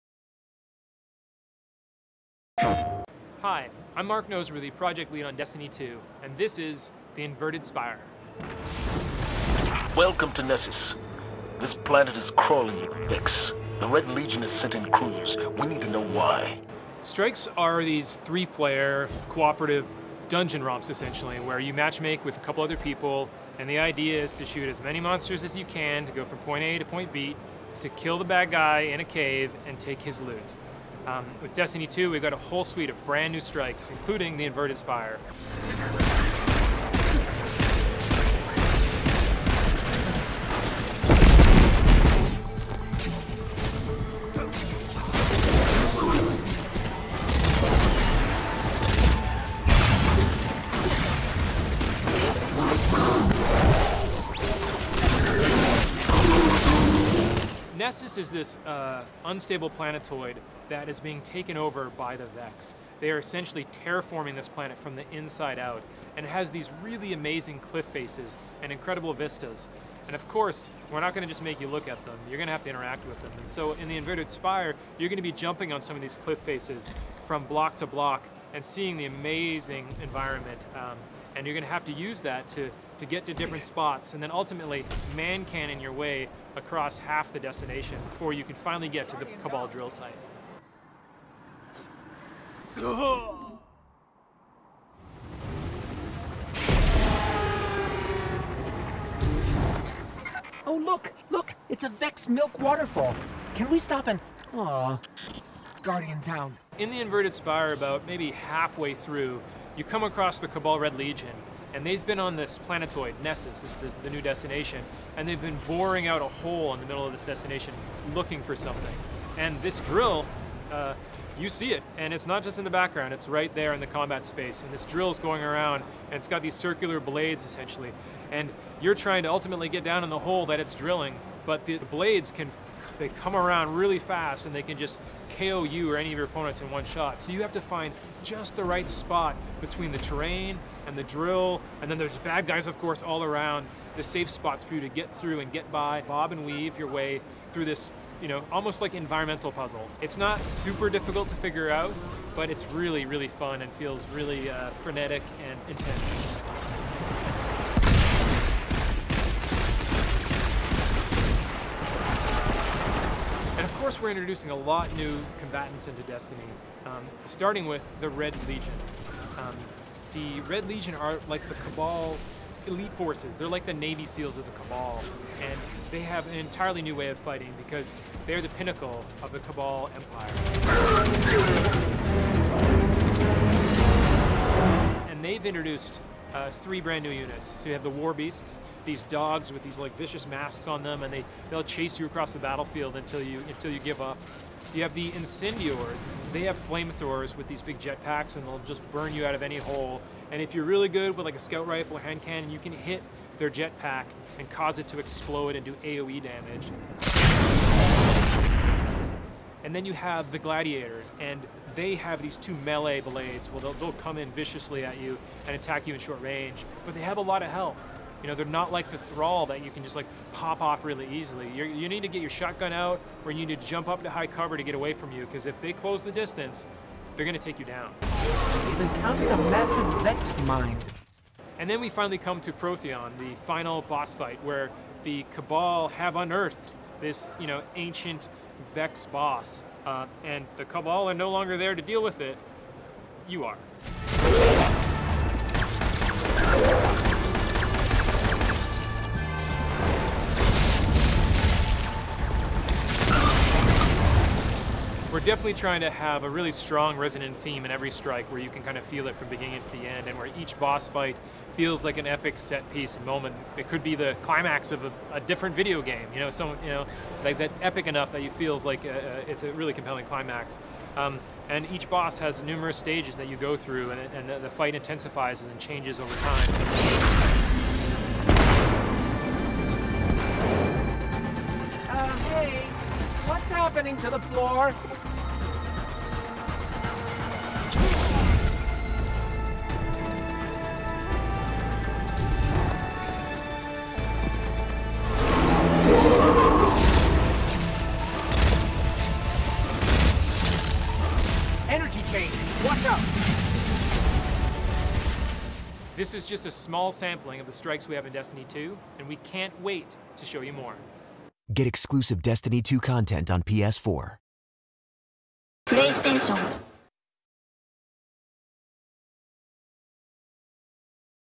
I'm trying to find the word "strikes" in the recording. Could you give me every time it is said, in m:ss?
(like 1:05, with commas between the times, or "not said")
0:17, 0:33, 4:17, 5:07.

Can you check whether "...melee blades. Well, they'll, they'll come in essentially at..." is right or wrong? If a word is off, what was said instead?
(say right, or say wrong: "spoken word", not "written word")
wrong: "viciously", not "essentially".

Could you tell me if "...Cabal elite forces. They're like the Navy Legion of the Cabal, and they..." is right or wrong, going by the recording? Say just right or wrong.
wrong.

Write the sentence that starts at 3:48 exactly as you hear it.
They've encountered a massive Vex mind.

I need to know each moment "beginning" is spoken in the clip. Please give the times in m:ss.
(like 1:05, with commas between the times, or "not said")
4:19.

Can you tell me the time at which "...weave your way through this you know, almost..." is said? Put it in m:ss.
2:26.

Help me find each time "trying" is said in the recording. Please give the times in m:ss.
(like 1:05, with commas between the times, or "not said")
2:08, 4:15.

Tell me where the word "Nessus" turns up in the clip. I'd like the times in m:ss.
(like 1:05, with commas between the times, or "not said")
0:10, 0:57, 1:53.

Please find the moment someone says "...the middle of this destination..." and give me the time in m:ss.
1:56.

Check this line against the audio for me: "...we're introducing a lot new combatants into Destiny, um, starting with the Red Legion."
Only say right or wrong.
right.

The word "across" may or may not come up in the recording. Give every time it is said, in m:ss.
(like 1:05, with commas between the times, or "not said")
1:26, 1:50, 3:12.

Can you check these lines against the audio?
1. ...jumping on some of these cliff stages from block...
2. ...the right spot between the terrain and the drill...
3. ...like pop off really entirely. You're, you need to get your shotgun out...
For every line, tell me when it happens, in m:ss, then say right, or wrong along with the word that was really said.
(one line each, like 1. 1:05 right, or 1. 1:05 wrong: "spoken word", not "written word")
1. 1:15 wrong: "faces", not "stages"
2. 2:18 right
3. 3:39 wrong: "easily", not "entirely".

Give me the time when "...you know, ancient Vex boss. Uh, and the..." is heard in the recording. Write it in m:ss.
3:57.